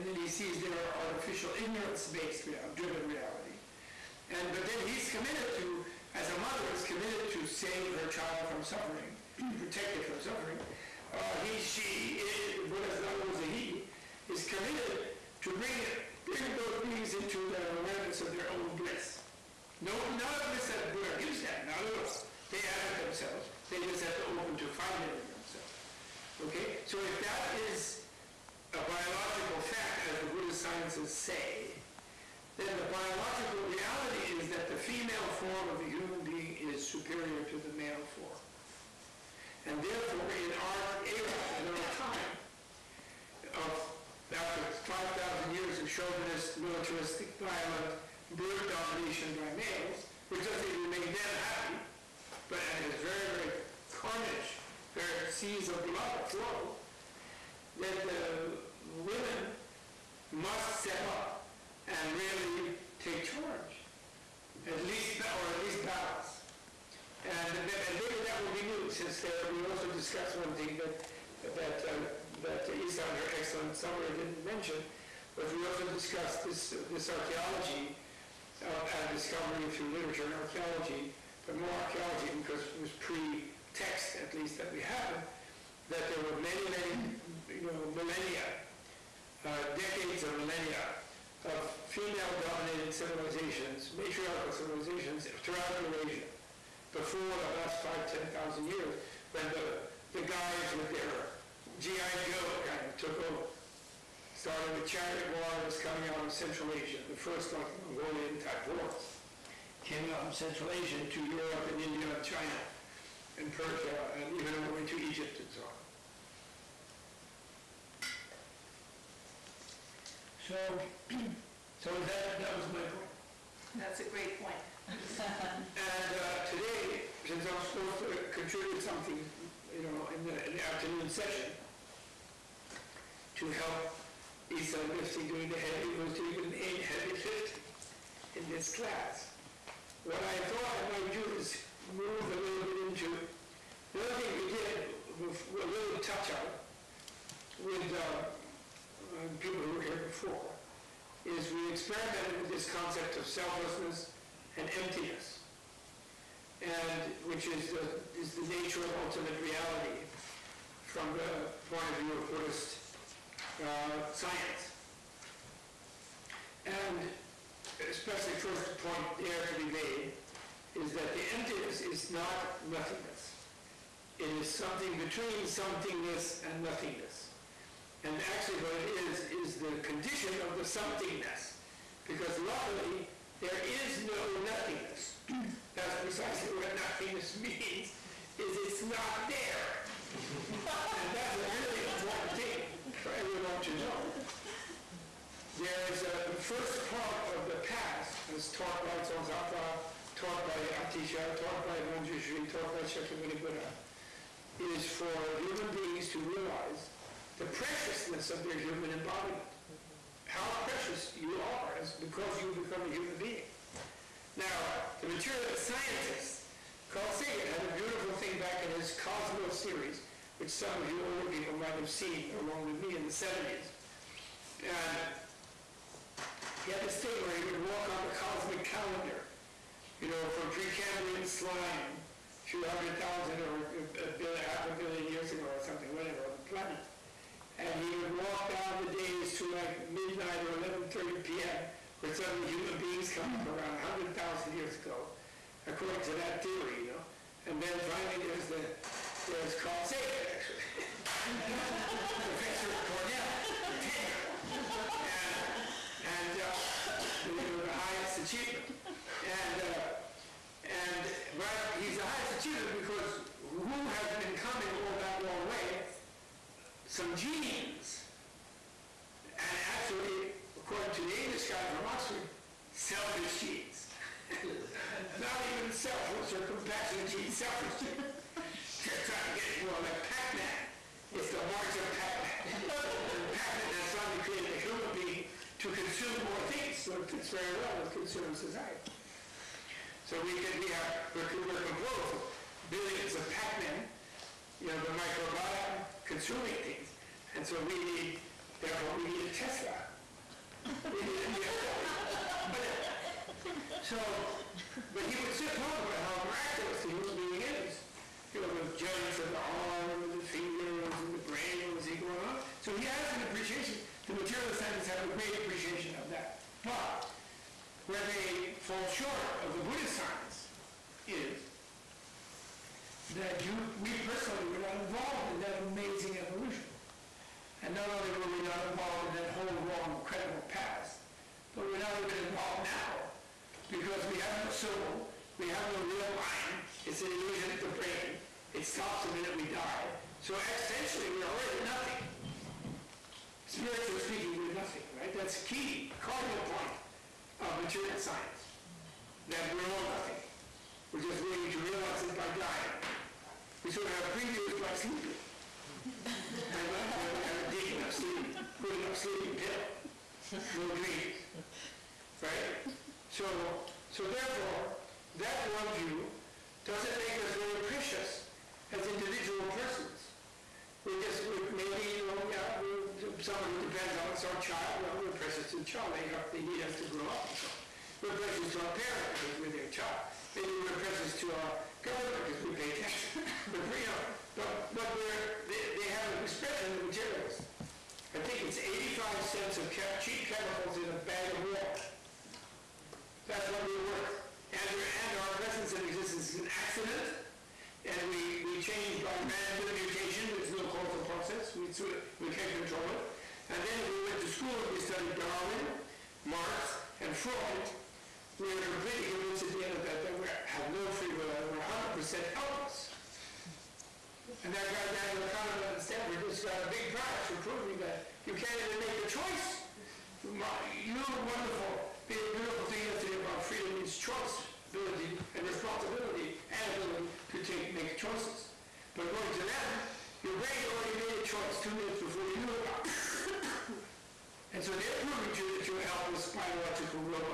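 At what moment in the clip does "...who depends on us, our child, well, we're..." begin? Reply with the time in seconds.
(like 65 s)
373 s.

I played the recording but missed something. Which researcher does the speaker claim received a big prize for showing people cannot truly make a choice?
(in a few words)
Daniel Kahneman.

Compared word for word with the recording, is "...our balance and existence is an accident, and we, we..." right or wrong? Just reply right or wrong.
wrong.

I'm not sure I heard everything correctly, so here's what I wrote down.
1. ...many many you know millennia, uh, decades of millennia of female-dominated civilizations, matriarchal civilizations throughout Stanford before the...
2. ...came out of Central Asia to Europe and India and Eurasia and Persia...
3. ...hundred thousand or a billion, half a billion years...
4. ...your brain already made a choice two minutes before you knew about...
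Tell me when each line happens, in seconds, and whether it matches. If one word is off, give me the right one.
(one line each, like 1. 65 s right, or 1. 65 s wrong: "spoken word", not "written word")
1. 86 s wrong: "Eurasia", not "Stanford"
2. 109 s wrong: "China", not "Eurasia"
3. 232 s right
4. 430 s right.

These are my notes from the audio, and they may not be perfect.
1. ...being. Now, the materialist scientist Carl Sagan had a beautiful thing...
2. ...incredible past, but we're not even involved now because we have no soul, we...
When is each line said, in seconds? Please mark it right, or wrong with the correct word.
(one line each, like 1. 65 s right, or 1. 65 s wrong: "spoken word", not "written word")
1. 213 s right
2. 329 s right.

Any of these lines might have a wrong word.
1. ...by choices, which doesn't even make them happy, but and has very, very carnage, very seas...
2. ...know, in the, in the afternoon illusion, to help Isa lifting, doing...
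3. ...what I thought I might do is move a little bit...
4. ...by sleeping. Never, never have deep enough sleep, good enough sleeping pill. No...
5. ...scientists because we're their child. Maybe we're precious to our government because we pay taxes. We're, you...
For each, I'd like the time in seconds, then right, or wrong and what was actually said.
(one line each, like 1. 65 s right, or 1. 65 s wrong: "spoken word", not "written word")
1. 49 s wrong: "males", not "choices"
2. 129 s wrong: "session", not "illusion"
3. 140 s right
4. 354 s right
5. 378 s wrong: "parents", not "scientists".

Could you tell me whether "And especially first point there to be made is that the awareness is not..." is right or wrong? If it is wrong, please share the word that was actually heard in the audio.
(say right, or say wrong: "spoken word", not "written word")
wrong: "emptiness", not "awareness".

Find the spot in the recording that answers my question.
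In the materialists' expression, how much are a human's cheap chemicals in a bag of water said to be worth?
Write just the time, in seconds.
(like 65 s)
388 s.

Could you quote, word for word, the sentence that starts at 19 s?
No, not a bliss that Buddha gives them, not at all.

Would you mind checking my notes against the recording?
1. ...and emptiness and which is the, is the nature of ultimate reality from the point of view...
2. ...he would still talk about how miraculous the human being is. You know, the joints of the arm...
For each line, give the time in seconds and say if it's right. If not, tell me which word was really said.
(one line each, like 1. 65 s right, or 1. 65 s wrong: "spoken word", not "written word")
1. 154 s right
2. 305 s right.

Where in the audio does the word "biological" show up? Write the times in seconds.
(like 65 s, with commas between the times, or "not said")
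28 s, 32 s, 436 s.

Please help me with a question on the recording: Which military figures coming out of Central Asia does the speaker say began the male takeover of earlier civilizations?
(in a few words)
Chariot warriors.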